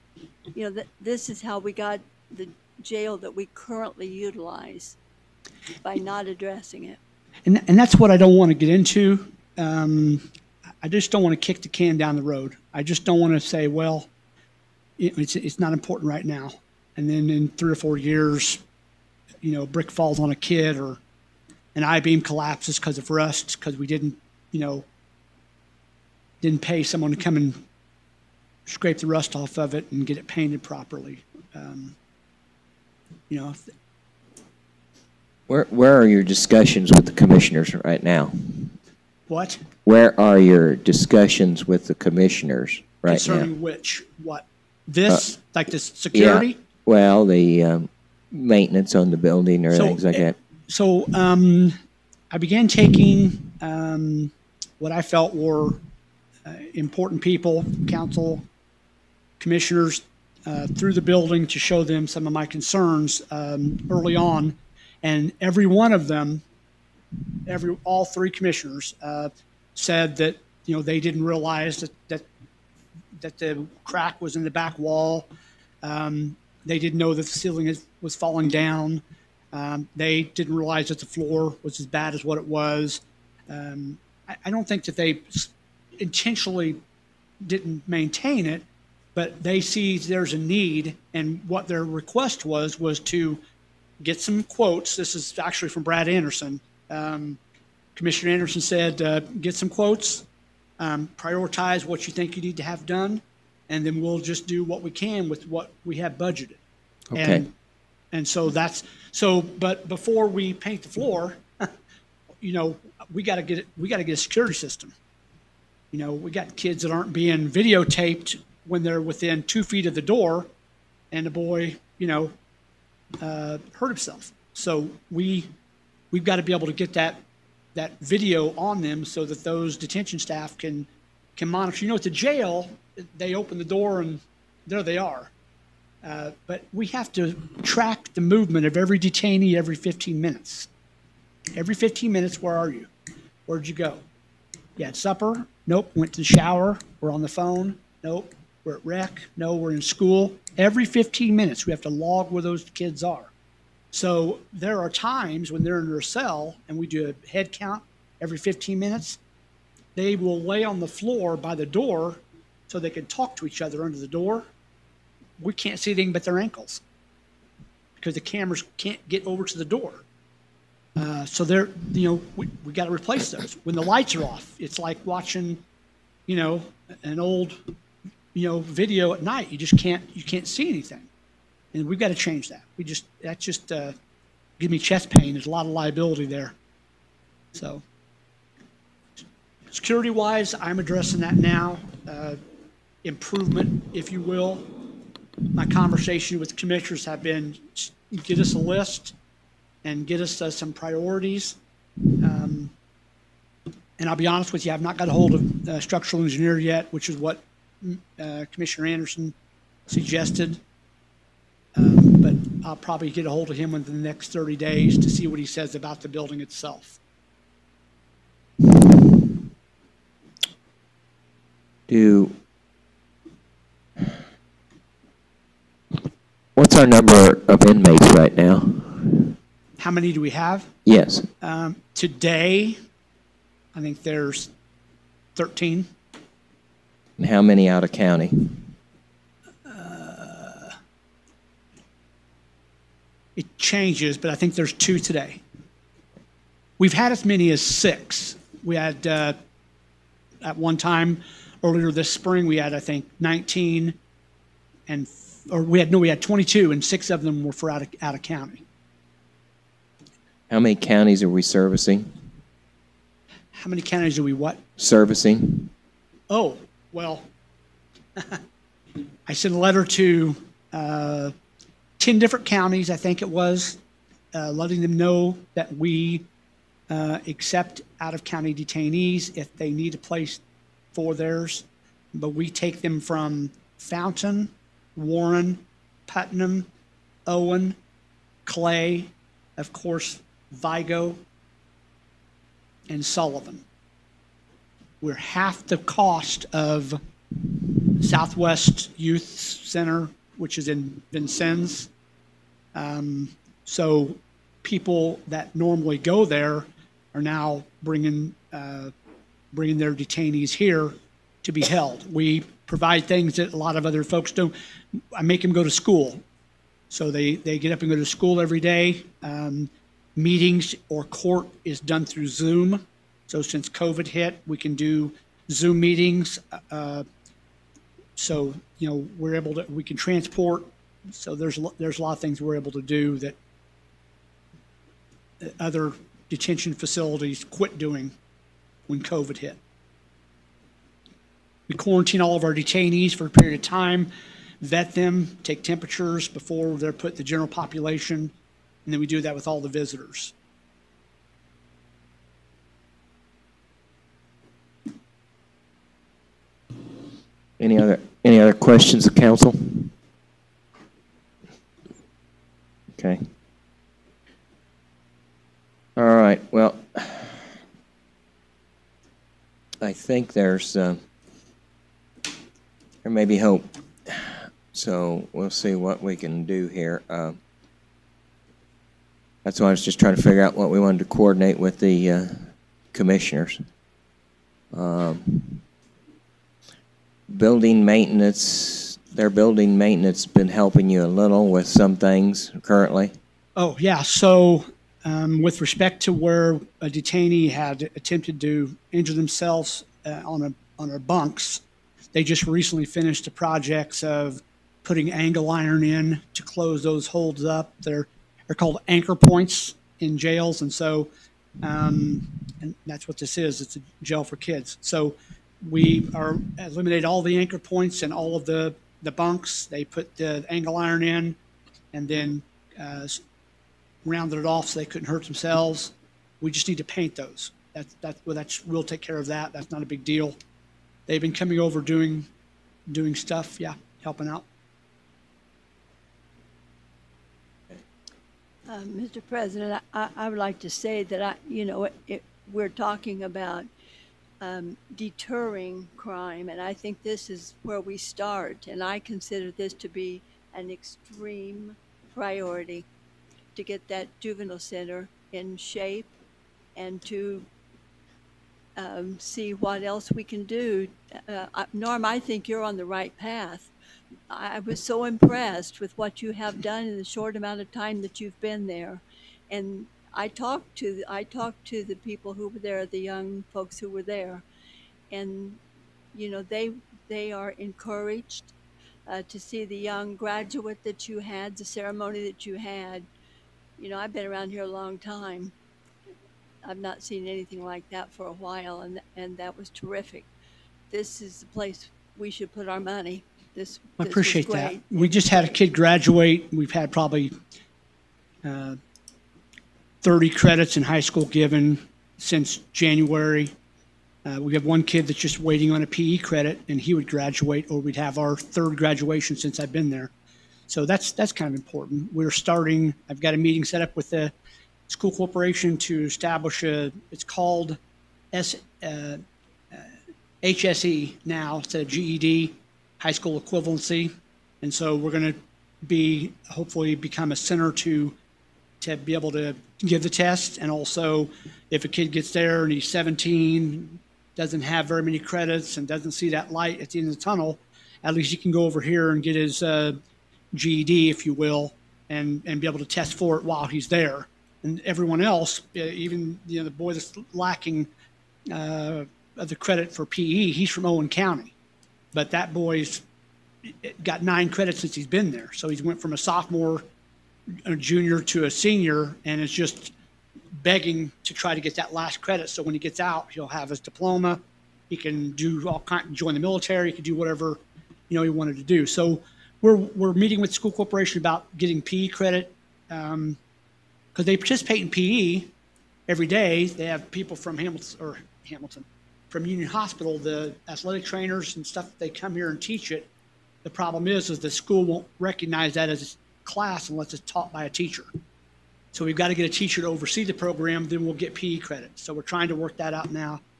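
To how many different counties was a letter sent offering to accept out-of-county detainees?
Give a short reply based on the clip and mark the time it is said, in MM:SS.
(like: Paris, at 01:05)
10, at 04:32.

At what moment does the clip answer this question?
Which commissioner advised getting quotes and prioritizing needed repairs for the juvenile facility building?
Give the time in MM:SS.
01:35.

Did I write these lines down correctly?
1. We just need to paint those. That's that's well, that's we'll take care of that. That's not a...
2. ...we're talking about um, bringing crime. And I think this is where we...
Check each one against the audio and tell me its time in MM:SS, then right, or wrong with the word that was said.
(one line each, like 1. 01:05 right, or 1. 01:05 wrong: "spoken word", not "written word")
1. 07:06 right
2. 07:22 wrong: "deterring", not "bringing".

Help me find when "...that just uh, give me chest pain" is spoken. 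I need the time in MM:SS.
03:03.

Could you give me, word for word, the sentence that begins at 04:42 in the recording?
But we take them from Fountain, Warren, Putnam, Owen, Clay, of course, Vigo, and Sullivan.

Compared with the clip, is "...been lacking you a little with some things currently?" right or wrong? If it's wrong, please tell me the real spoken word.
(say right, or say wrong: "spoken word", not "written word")
wrong: "helping", not "lacking".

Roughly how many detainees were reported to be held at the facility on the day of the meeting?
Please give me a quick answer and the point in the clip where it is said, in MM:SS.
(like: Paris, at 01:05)
13, at 03:55.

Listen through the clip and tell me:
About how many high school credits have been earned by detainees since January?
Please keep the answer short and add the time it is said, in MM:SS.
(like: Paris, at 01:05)
30, at 08:20.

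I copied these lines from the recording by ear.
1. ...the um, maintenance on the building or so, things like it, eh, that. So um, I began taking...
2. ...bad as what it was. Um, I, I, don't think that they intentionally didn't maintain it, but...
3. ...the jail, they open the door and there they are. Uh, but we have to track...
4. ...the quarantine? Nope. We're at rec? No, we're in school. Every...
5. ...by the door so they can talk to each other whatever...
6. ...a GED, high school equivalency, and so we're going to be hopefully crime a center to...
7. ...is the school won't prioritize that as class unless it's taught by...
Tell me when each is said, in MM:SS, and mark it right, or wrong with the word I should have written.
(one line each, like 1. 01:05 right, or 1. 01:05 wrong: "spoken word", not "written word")
1. 00:47 right
2. 01:21 right
3. 02:12 right
4. 02:27 wrong: "phone", not "quarantine"
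5. 02:41 wrong: "under", not "whatever"
6. 08:41 wrong: "become", not "crime"
7. 09:44 wrong: "recognize", not "prioritize".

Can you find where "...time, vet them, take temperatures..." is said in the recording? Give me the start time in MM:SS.
05:43.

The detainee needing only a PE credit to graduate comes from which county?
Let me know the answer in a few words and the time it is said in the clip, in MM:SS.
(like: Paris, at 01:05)
Owen County, at 09:10.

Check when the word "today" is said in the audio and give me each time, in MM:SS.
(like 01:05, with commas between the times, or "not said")
03:51, 04:04.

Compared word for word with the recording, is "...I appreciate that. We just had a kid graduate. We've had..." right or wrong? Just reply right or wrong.
right.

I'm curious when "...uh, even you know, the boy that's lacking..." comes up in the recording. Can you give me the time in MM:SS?
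09:05.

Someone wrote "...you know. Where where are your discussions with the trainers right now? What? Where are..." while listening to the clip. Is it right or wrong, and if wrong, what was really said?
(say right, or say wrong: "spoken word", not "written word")
wrong: "commissioners", not "trainers".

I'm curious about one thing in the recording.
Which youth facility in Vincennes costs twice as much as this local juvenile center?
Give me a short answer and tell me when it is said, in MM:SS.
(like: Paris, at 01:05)
Southwest Youth Center, at 04:57.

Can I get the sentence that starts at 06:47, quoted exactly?
They're they're called anchor points in jails, and so um, and that's what this is.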